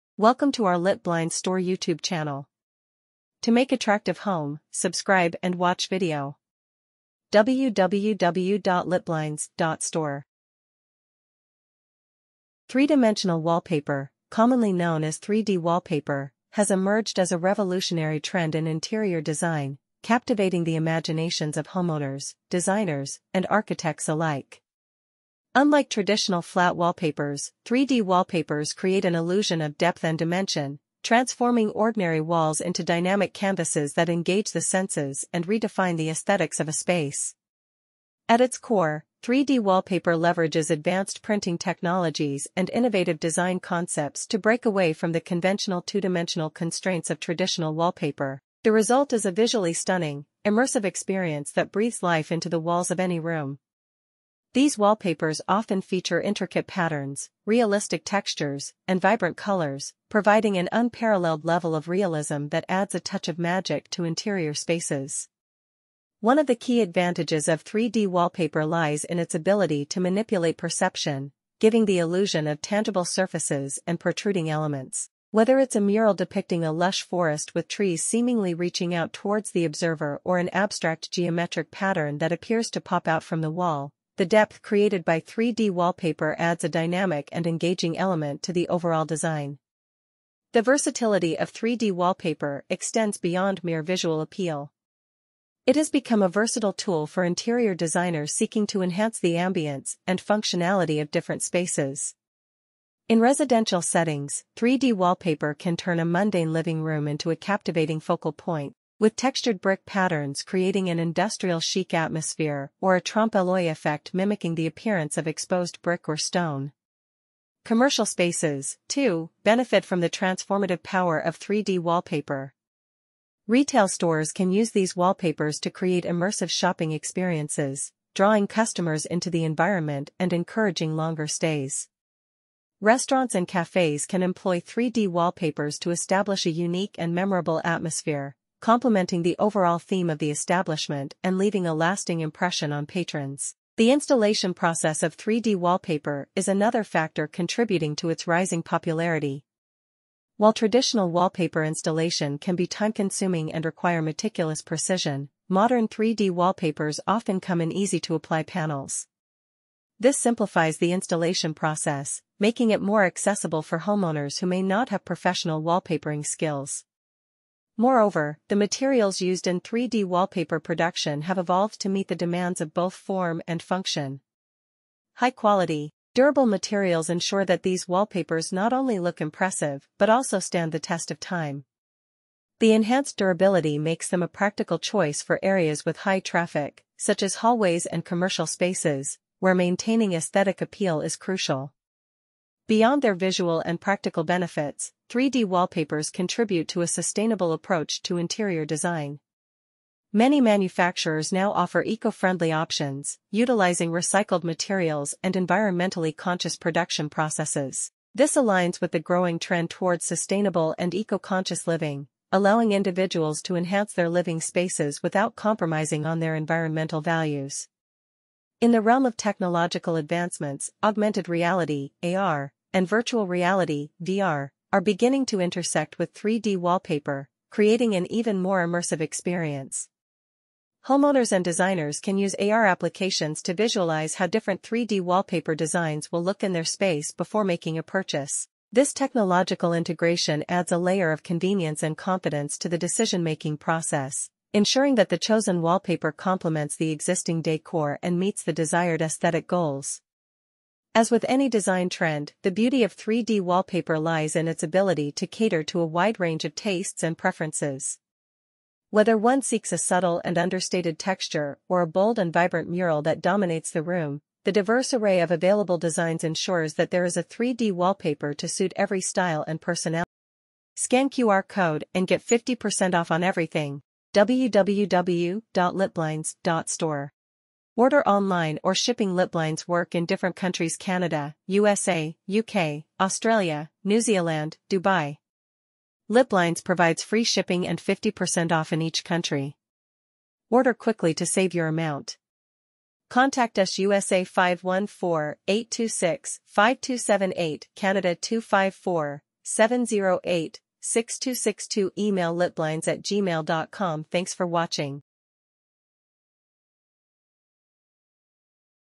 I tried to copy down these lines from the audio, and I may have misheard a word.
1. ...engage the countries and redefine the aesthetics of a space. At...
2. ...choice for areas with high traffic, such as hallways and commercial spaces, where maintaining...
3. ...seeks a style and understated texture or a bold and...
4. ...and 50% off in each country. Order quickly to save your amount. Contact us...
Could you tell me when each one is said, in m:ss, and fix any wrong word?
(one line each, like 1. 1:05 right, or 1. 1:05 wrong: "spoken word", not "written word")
1. 0:34 wrong: "senses", not "countries"
2. 3:04 right
3. 4:19 wrong: "subtle", not "style"
4. 4:47 right.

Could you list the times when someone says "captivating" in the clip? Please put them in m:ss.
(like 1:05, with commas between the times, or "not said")
0:20, 1:47.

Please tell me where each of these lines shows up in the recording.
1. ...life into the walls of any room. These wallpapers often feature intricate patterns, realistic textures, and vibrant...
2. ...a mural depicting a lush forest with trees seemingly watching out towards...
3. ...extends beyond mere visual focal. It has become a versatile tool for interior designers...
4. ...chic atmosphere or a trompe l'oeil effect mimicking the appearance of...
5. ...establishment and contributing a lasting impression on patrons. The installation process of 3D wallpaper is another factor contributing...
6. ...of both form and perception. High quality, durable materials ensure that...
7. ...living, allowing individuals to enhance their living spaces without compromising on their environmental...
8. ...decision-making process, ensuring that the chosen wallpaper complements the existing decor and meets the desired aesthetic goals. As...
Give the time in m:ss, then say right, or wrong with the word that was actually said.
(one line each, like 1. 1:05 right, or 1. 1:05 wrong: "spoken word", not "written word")
1. 0:52 right
2. 1:15 wrong: "reaching", not "watching"
3. 1:32 wrong: "appeal", not "focal"
4. 1:51 right
5. 2:20 wrong: "leaving", not "contributing"
6. 2:52 wrong: "function", not "perception"
7. 3:31 right
8. 4:02 right.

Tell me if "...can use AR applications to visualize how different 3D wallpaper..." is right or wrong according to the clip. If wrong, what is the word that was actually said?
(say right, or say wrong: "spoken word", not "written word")
right.